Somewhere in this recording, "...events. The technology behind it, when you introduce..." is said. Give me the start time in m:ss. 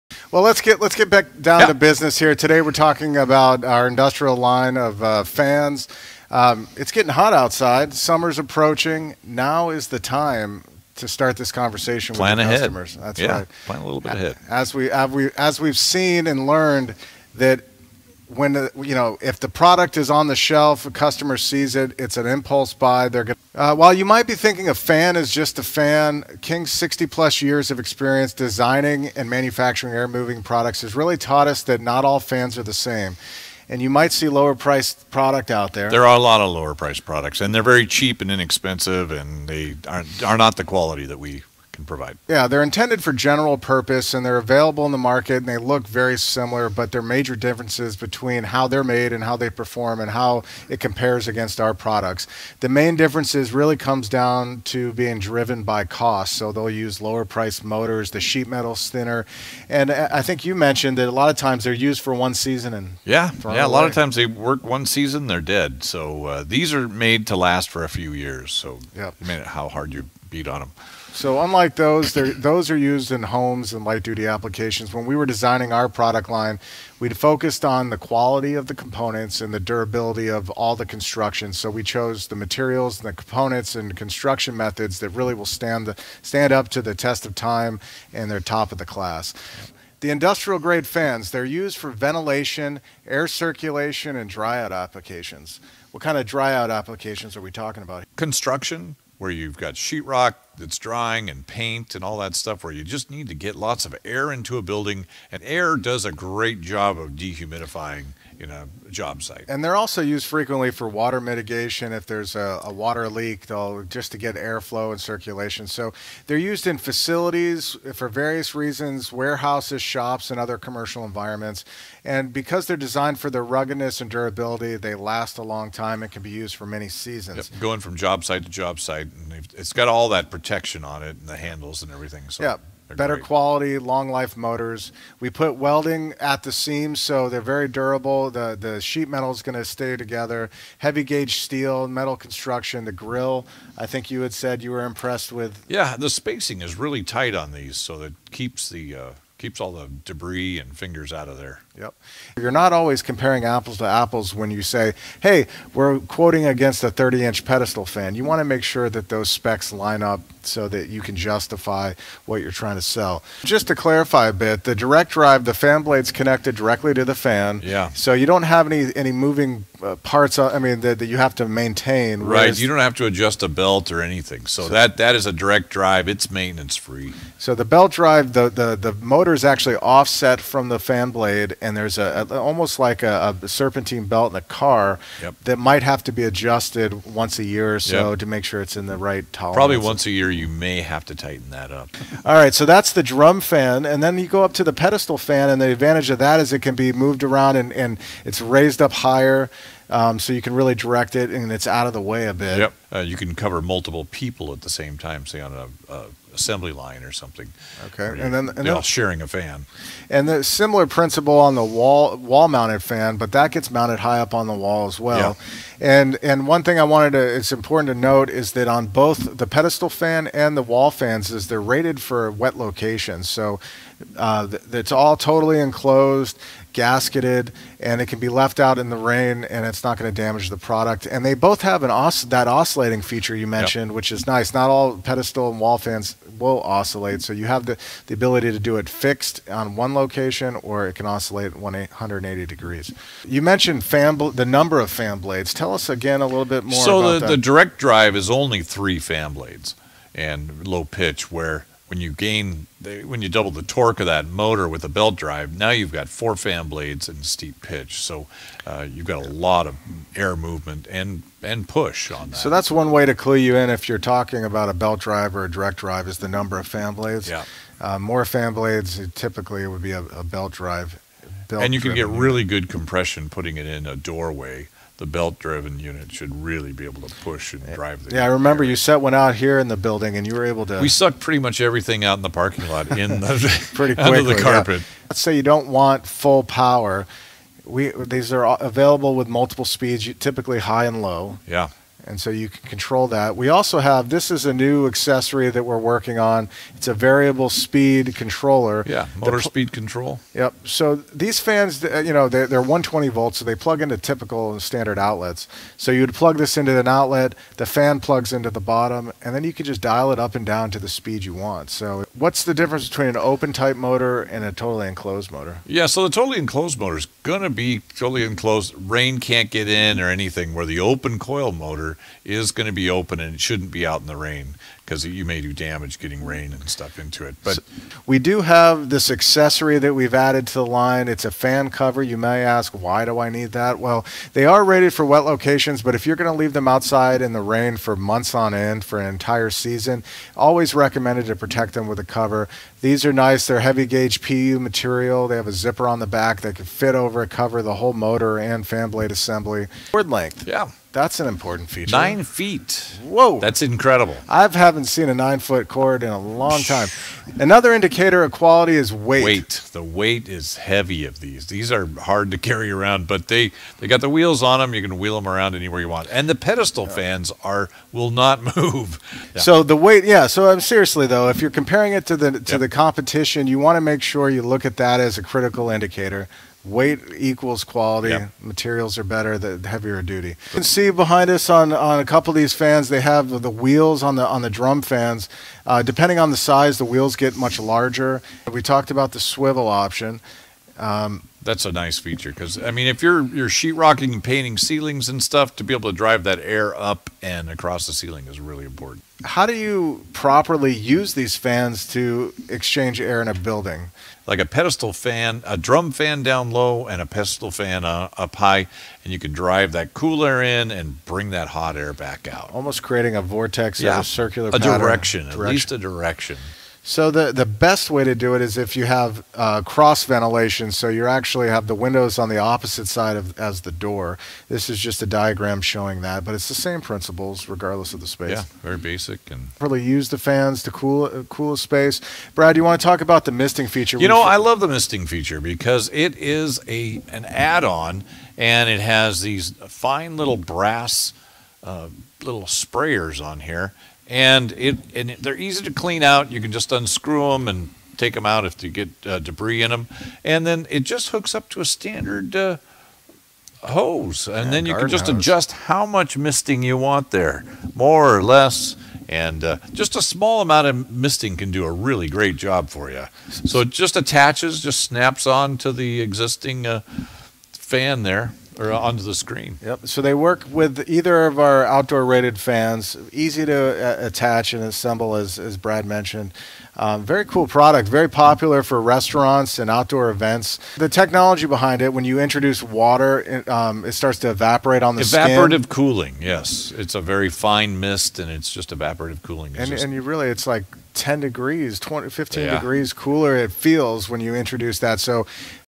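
8:00.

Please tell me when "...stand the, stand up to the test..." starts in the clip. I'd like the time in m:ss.
1:25.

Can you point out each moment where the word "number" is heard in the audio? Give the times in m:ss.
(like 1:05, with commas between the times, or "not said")
4:04, 4:26.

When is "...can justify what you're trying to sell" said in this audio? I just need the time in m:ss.
2:41.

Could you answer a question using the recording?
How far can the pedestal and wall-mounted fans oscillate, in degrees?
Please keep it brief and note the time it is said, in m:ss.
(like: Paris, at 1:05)
180, at 4:01.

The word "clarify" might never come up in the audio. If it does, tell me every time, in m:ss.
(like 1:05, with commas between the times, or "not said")
2:43.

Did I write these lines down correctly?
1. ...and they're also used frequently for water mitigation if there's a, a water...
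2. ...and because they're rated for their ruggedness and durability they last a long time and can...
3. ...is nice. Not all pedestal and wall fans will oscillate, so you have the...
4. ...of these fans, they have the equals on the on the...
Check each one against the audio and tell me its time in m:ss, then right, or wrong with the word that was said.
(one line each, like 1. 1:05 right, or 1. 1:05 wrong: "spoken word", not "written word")
1. 1:49 right
2. 2:02 wrong: "designed", not "rated"
3. 3:54 right
4. 6:22 wrong: "wheels", not "equals".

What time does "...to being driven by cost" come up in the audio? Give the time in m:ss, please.
0:54.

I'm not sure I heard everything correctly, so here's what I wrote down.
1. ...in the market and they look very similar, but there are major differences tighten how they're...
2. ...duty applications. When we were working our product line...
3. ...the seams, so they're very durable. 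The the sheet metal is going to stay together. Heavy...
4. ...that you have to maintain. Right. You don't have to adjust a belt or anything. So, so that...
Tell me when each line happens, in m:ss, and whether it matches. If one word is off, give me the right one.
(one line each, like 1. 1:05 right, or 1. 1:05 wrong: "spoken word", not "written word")
1. 0:44 wrong: "between", not "tighten"
2. 1:14 wrong: "designing", not "working"
3. 2:16 right
4. 2:50 right.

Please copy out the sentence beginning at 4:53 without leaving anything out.
We also have, this is a new accessory that we're working on.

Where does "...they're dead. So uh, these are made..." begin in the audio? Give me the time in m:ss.
1:05.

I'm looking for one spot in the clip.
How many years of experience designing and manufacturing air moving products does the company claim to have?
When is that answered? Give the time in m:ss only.
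0:26.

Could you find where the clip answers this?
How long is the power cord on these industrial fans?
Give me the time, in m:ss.
5:51.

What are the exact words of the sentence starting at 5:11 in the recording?
So what's the difference between an open type motor and a totally enclosed motor?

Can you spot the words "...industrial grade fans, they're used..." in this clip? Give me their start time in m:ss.
1:30.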